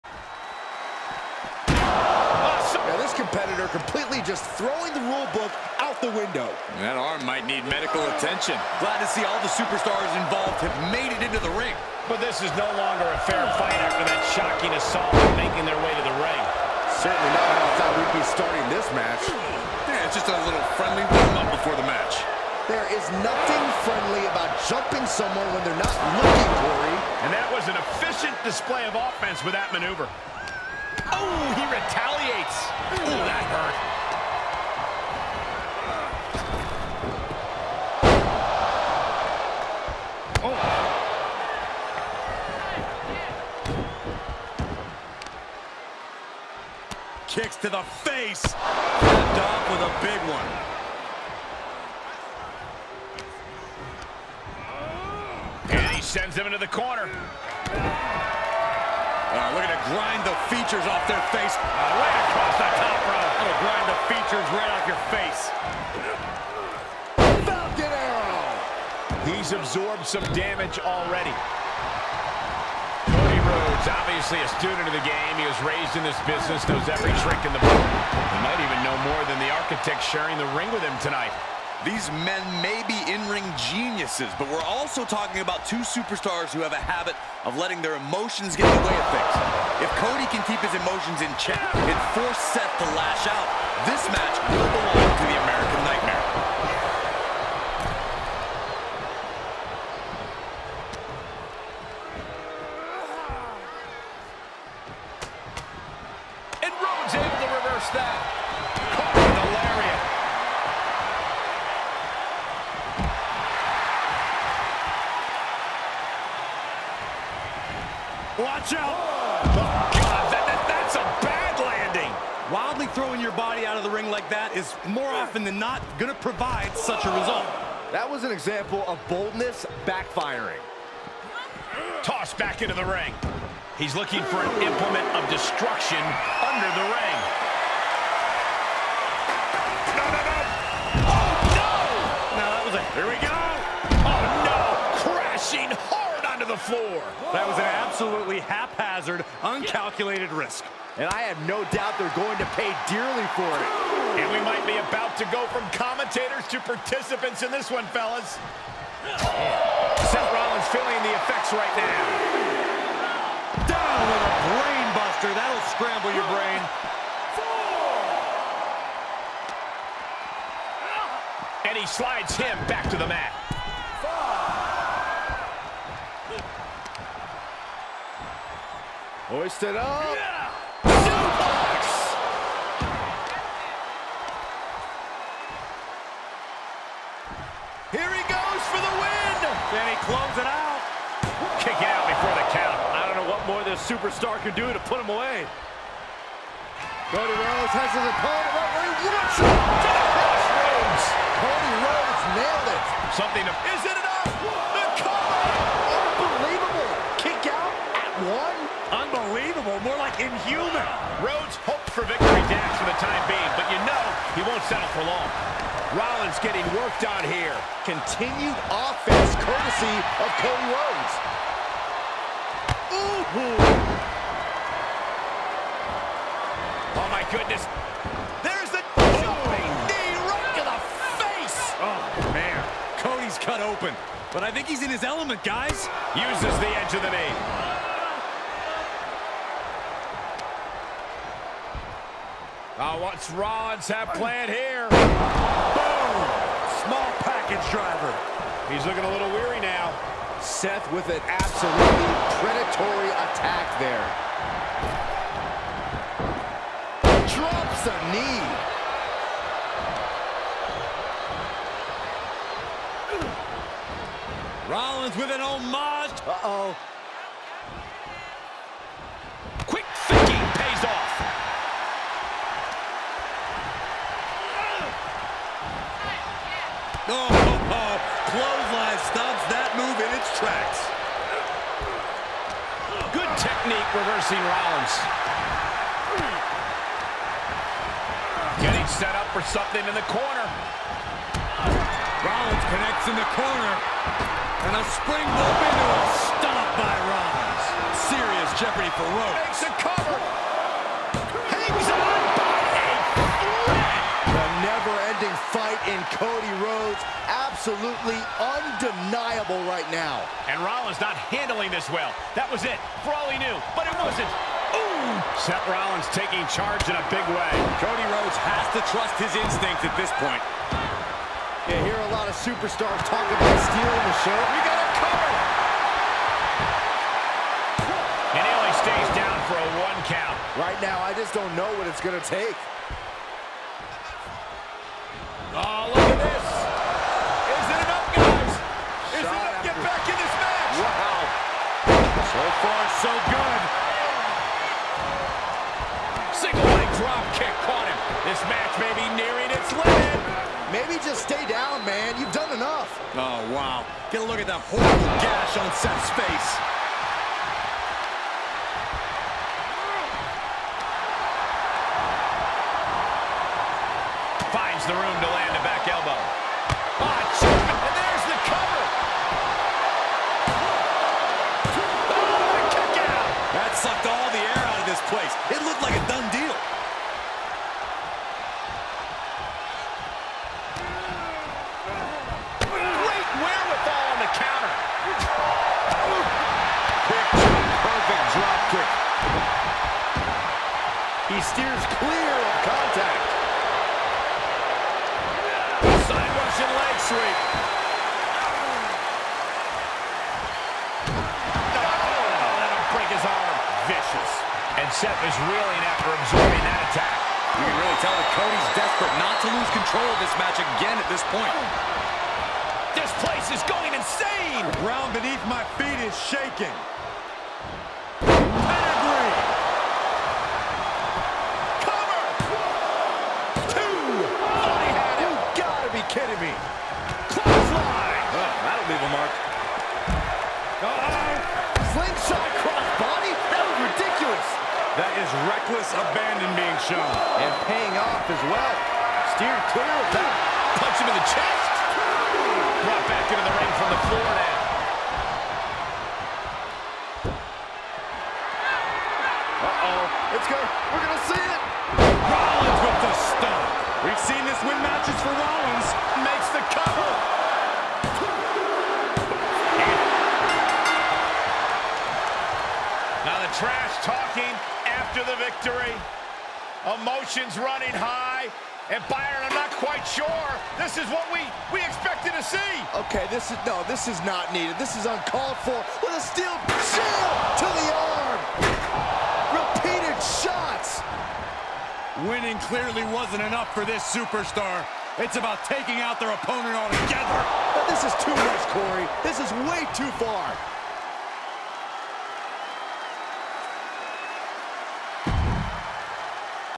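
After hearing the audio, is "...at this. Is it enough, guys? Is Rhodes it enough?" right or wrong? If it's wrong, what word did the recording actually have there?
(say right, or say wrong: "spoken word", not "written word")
wrong: "Shot", not "Rhodes".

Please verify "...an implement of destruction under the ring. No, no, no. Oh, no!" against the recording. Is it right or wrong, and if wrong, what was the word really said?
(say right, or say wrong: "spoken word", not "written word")
right.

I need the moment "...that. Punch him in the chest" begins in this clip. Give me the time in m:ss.
7:20.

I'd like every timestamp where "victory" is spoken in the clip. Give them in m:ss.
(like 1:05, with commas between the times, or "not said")
3:32, 7:45.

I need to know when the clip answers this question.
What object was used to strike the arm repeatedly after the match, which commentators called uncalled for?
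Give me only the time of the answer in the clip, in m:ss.
7:56.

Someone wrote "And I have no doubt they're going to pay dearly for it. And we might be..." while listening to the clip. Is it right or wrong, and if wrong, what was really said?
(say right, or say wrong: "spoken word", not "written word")
right.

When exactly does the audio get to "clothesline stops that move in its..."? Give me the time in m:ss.
4:38.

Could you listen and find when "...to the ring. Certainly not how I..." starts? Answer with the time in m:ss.
0:15.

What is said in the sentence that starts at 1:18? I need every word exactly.
He might even know more than the architect sharing the ring with him tonight.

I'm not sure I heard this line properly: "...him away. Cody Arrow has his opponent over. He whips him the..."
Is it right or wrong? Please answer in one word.
wrong.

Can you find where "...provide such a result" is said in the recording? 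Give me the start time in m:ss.
2:06.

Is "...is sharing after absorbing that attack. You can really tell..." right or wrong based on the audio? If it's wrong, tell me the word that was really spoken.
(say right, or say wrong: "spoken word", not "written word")
wrong: "reeling", not "sharing".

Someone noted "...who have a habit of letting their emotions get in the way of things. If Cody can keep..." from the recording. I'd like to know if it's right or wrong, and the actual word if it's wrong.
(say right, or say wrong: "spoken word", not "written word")
right.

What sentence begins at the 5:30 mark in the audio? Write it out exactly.
Right now, I just don't know what it's going to take.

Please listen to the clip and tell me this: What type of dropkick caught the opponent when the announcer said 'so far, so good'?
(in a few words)
Single leg drop kick.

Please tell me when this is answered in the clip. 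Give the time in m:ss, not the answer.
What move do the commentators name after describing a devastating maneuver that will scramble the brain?
2:44.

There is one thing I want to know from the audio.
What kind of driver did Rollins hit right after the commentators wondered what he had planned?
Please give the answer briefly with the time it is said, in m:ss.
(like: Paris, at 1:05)
Small package driver, at 4:06.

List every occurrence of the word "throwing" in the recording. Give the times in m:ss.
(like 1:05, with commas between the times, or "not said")
0:04, 2:02.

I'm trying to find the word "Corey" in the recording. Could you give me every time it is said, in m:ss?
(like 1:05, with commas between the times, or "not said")
0:26, 8:08.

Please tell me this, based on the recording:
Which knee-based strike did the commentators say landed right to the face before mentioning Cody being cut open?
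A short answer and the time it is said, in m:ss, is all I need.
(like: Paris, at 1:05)
Jumping knee, at 3:49.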